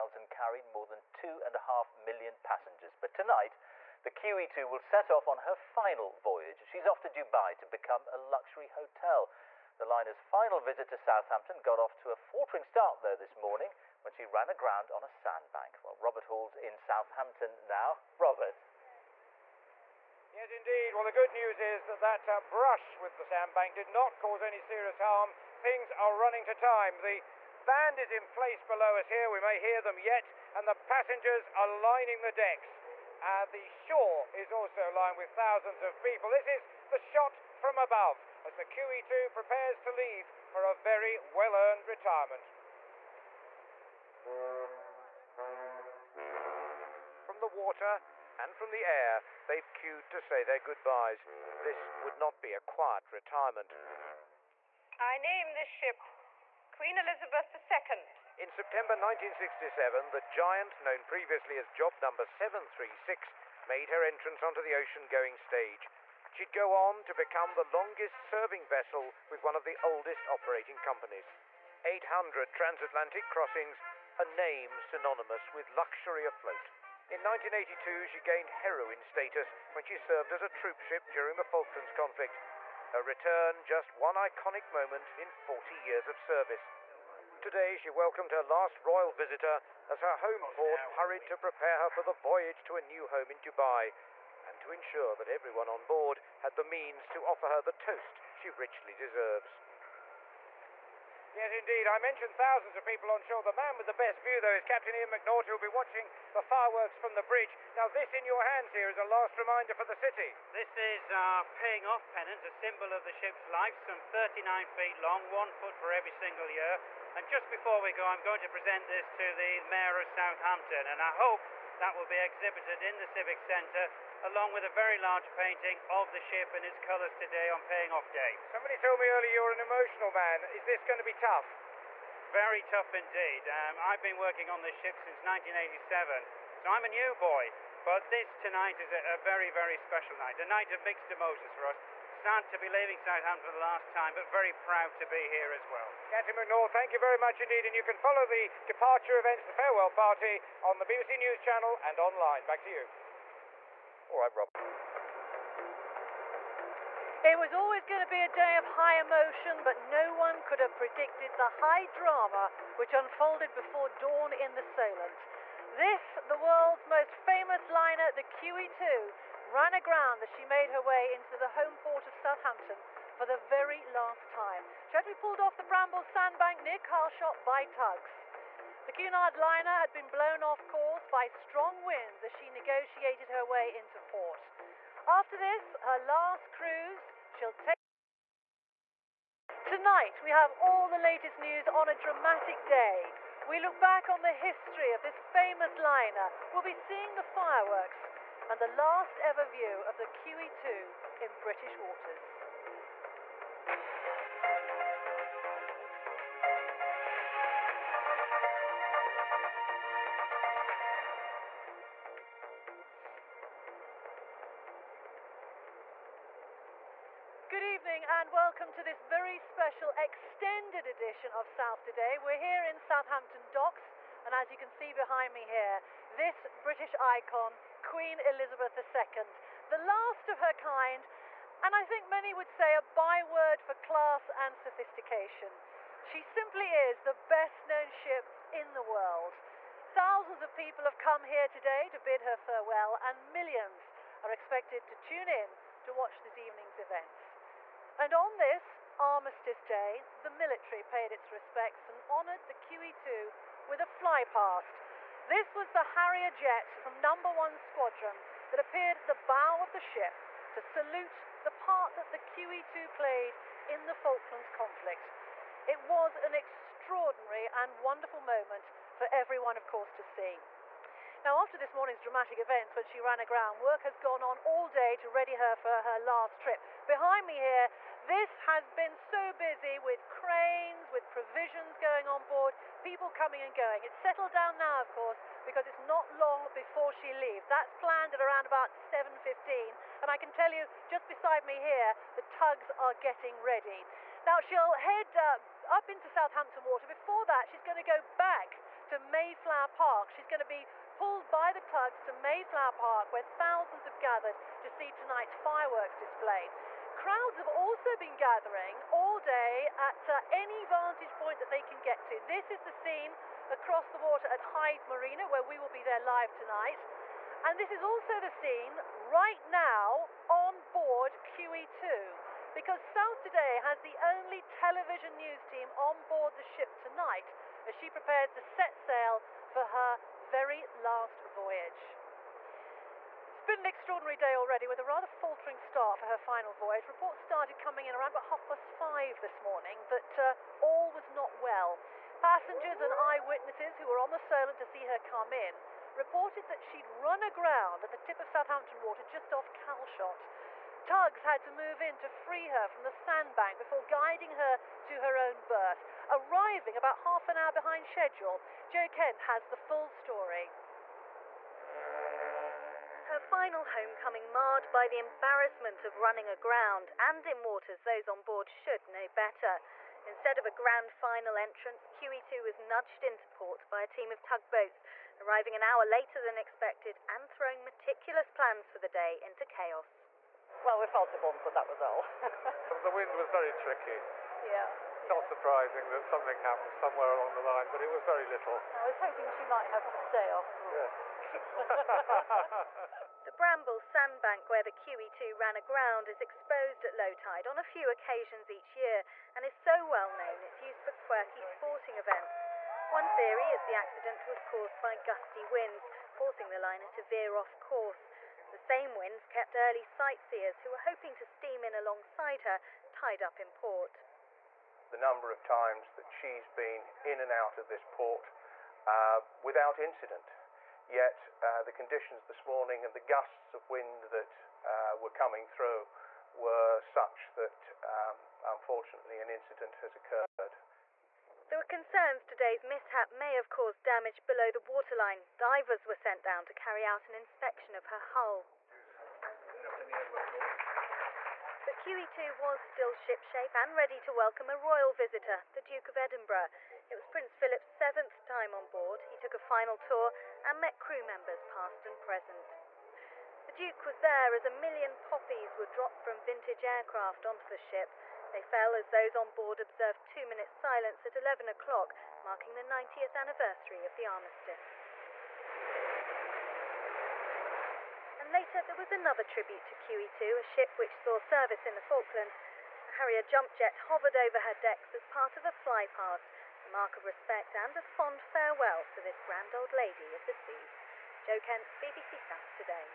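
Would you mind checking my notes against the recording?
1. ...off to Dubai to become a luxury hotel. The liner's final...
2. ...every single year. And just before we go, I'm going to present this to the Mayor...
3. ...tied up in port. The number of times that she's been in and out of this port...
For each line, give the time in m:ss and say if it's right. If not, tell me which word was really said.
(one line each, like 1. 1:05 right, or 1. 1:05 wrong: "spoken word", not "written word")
1. 0:06 right
2. 1:55 right
3. 6:52 right.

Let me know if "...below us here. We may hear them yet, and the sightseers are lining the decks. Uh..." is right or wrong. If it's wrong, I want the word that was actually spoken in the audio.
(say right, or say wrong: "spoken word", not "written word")
wrong: "passengers", not "sightseers".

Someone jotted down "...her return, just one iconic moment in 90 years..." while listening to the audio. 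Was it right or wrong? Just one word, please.
wrong.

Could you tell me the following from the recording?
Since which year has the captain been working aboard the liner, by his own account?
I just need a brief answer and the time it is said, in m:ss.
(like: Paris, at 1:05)
1987, at 2:15.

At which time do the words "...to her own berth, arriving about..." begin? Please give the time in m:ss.
5:54.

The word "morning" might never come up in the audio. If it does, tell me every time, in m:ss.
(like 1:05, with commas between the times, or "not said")
0:13, 3:38, 4:31, 5:39, 7:02.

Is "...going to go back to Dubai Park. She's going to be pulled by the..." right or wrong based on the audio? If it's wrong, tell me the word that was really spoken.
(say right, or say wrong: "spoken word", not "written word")
wrong: "Mayflower", not "Dubai".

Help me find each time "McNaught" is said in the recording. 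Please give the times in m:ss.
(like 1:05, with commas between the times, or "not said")
1:45, 2:26.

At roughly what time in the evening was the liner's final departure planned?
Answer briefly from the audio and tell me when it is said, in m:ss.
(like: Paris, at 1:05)
7.15, at 4:48.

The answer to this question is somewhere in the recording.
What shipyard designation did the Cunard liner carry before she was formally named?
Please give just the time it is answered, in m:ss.
1:01.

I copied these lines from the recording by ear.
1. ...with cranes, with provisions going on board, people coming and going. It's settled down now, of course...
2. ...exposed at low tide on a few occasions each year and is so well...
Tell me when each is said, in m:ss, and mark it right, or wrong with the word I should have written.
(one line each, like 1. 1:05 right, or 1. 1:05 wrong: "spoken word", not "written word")
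1. 4:39 right
2. 6:36 right.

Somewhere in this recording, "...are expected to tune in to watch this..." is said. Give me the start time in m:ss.
4:04.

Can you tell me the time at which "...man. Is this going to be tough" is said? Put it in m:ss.
2:10.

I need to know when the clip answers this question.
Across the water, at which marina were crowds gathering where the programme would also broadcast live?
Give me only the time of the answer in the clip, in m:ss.
5:14.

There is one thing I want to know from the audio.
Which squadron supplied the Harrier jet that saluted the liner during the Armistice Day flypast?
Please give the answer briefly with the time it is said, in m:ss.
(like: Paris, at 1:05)
Number One Squadron, at 4:16.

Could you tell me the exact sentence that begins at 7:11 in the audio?
There were concerns today's mishap may have caused damage below the waterline.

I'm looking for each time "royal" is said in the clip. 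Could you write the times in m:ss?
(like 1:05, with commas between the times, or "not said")
1:28, 7:24.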